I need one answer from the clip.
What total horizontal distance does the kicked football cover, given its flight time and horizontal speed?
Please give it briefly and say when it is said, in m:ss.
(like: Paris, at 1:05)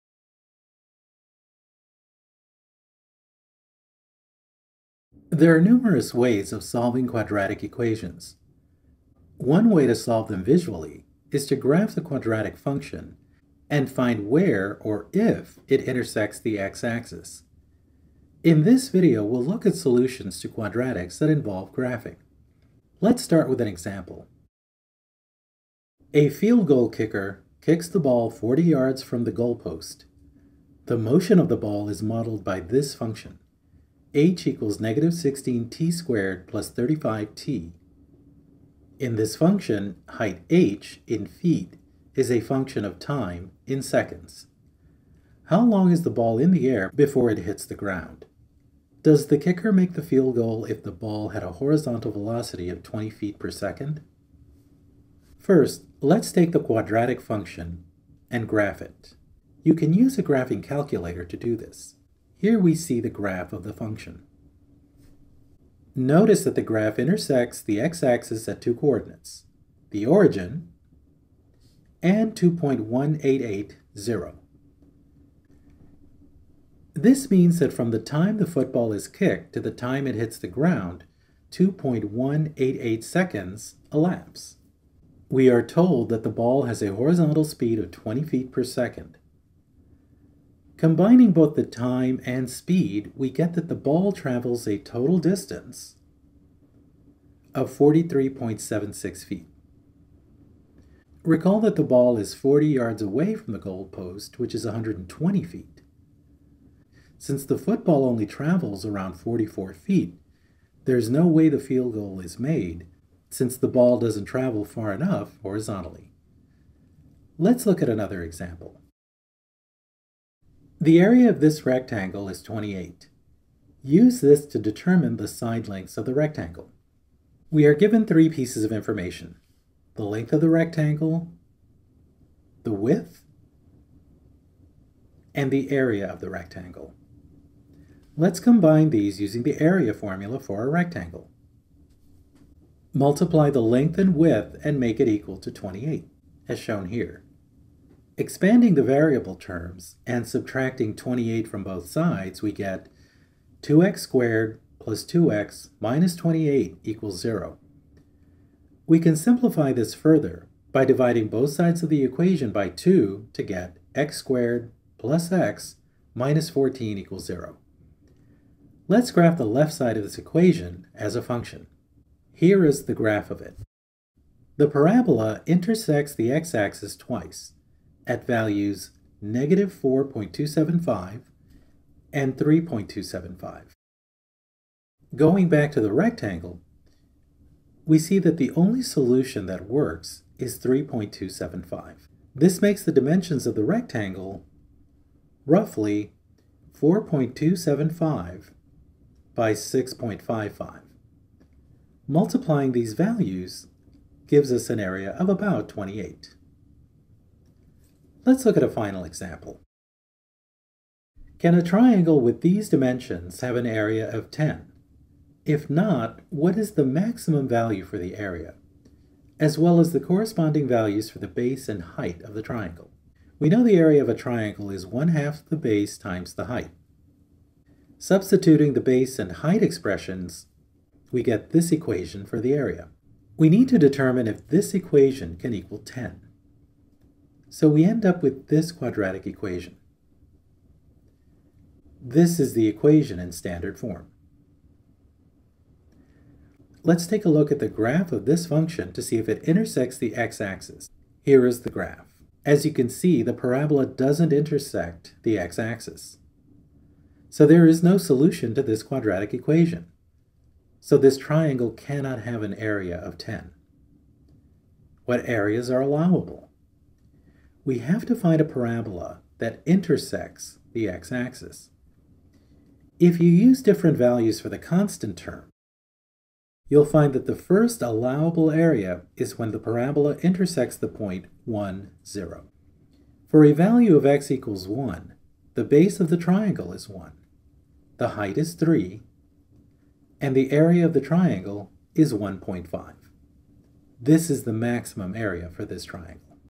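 43.76 feet, at 1:37.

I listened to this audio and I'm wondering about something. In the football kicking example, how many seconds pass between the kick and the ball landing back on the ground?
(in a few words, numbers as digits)
2.188 seconds.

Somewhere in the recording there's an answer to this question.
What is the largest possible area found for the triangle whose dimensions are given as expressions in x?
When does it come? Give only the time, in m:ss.
4:52.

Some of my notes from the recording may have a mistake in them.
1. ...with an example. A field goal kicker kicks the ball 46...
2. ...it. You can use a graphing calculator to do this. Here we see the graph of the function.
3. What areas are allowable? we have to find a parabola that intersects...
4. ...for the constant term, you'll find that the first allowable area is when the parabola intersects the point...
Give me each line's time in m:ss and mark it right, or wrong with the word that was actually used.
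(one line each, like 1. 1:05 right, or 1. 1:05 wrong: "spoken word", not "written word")
1. 0:23 wrong: "40", not "46"
2. 0:58 right
3. 4:25 right
4. 4:34 right.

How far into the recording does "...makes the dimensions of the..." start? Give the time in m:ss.
3:12.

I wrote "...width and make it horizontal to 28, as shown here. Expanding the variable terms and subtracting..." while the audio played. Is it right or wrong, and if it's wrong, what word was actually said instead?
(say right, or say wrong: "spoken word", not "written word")
wrong: "equal", not "horizontal".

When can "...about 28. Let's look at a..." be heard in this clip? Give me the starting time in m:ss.
3:25.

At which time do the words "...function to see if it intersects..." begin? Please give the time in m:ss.
4:08.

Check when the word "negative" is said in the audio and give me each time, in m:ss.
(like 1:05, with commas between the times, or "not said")
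0:34, 2:59.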